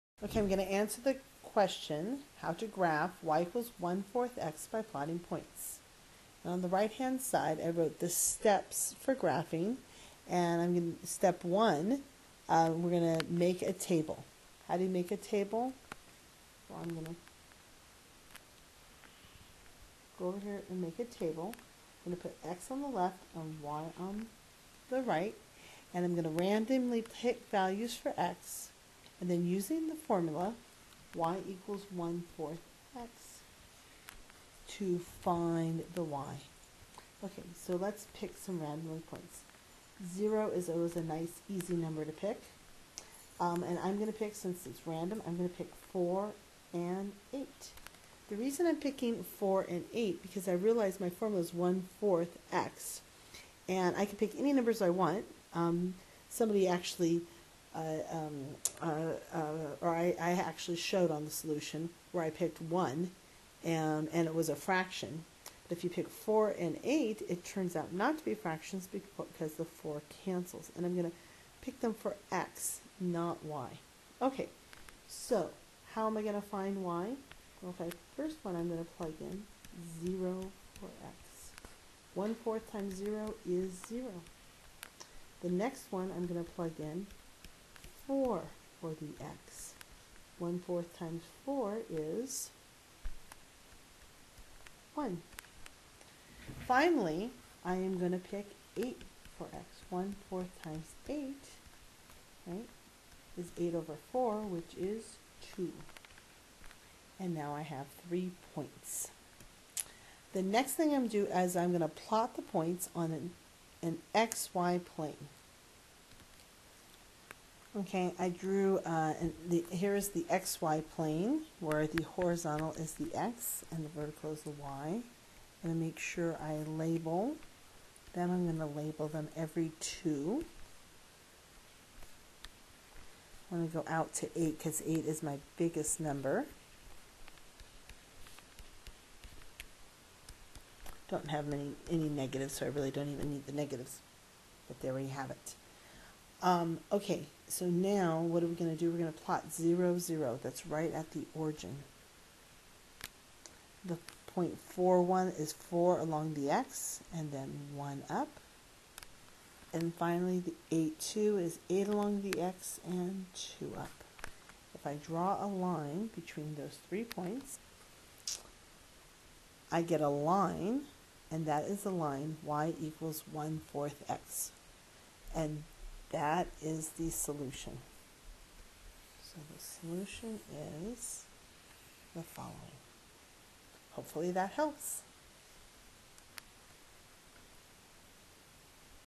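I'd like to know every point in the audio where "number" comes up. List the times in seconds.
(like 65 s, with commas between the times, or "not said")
41 s, 54 s, 136 s.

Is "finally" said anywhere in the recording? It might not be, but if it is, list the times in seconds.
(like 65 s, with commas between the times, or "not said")
96 s, 159 s.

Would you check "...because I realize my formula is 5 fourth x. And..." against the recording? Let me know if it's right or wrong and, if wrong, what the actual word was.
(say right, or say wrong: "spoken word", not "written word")
wrong: "1", not "5".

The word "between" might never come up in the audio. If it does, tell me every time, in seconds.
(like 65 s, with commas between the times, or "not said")
166 s.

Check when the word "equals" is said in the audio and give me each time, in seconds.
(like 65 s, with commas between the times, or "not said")
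3 s, 31 s, 172 s.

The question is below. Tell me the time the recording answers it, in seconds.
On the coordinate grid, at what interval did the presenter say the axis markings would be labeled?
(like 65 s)
129 s.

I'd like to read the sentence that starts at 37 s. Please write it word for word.
Okay, so let's pick some random points.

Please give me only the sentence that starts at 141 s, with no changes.
Don't have many, any negatives, so I really don't even need the negatives.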